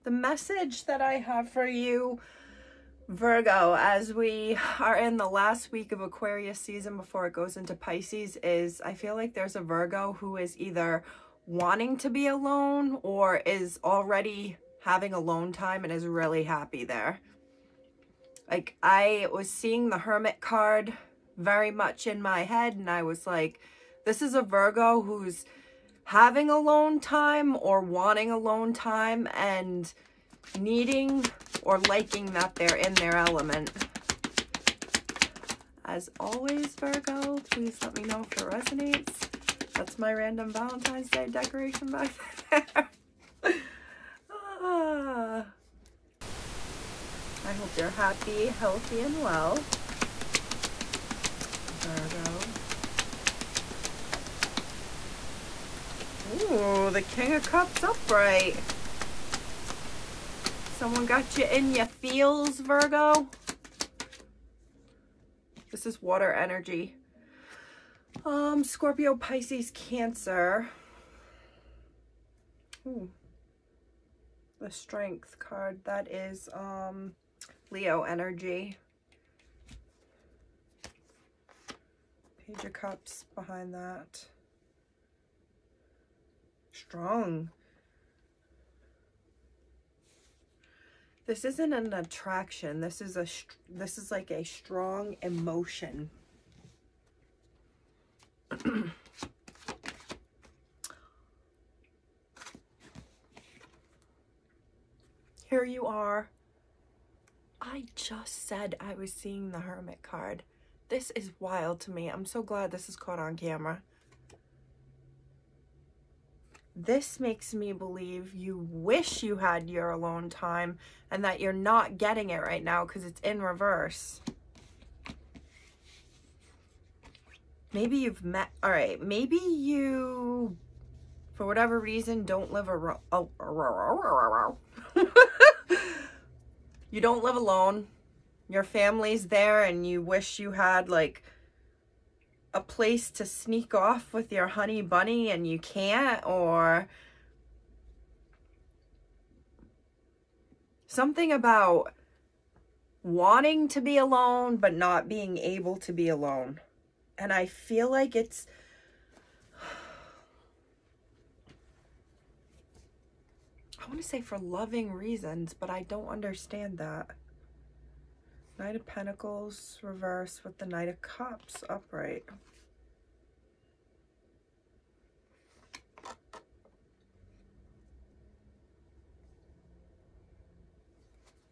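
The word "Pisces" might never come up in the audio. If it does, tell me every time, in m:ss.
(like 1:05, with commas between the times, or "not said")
0:07, 1:09.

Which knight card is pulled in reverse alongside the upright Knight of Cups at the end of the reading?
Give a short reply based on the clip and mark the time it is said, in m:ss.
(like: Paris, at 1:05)
Knight of Pentacles, at 2:48.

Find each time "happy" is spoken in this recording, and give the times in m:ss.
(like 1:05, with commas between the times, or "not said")
0:16, 0:47.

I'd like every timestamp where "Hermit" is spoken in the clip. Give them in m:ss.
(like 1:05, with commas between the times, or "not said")
0:19, 1:49.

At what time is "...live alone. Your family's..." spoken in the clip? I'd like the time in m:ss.
2:17.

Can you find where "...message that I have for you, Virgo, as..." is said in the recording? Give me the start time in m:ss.
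0:00.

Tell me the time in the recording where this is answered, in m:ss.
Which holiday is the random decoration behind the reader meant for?
0:40.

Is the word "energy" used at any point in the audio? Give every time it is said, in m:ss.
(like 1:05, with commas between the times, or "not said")
1:06, 1:18.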